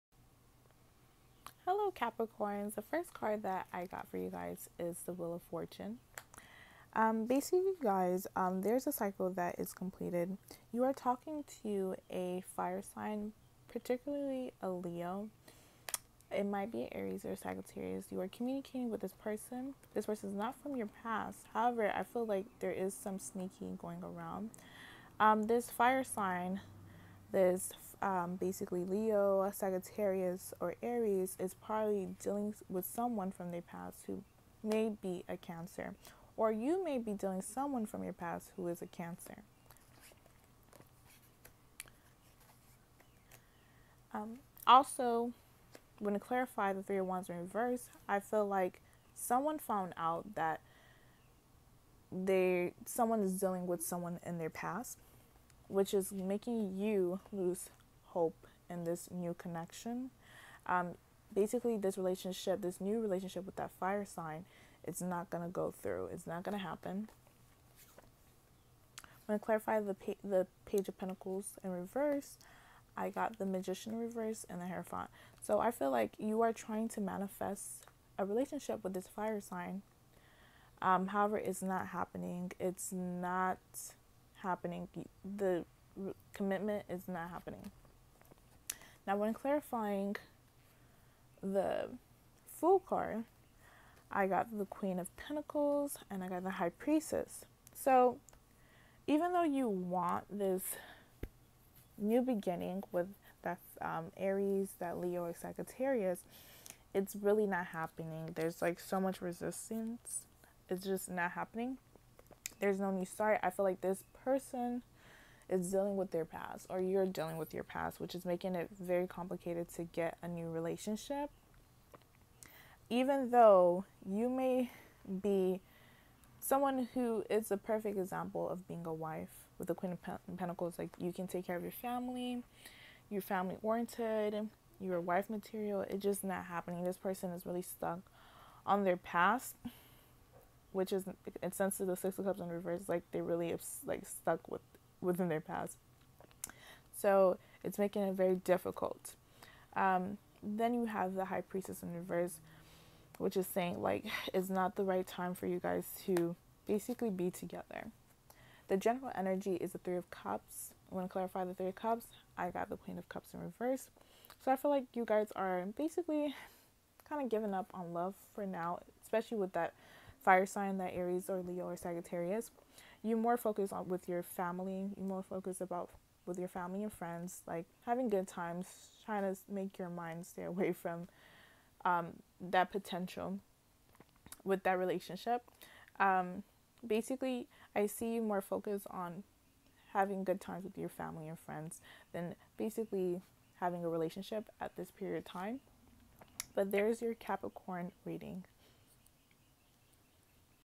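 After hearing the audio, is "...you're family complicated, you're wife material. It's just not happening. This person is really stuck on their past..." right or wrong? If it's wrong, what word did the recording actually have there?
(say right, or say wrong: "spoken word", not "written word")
wrong: "oriented", not "complicated".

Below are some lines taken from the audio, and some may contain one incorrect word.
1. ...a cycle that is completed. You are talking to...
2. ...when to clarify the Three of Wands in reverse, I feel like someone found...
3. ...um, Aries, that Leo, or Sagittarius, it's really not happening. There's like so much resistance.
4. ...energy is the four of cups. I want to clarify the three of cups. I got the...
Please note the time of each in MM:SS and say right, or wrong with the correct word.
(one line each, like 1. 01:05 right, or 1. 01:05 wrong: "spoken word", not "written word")
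1. 00:08 right
2. 00:45 right
3. 01:43 right
4. 02:39 wrong: "three", not "four".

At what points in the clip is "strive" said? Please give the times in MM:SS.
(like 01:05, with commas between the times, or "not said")
not said.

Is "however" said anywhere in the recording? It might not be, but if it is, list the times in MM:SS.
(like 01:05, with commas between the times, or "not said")
00:21, 01:21.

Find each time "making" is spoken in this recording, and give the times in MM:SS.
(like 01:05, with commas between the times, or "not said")
00:56, 01:58, 02:27.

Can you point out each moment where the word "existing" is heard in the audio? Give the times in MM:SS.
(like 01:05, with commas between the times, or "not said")
not said.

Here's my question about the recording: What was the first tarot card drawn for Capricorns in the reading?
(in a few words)
Wheel of Fortune.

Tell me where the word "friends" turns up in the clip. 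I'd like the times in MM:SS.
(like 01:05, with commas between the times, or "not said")
02:56, 03:11.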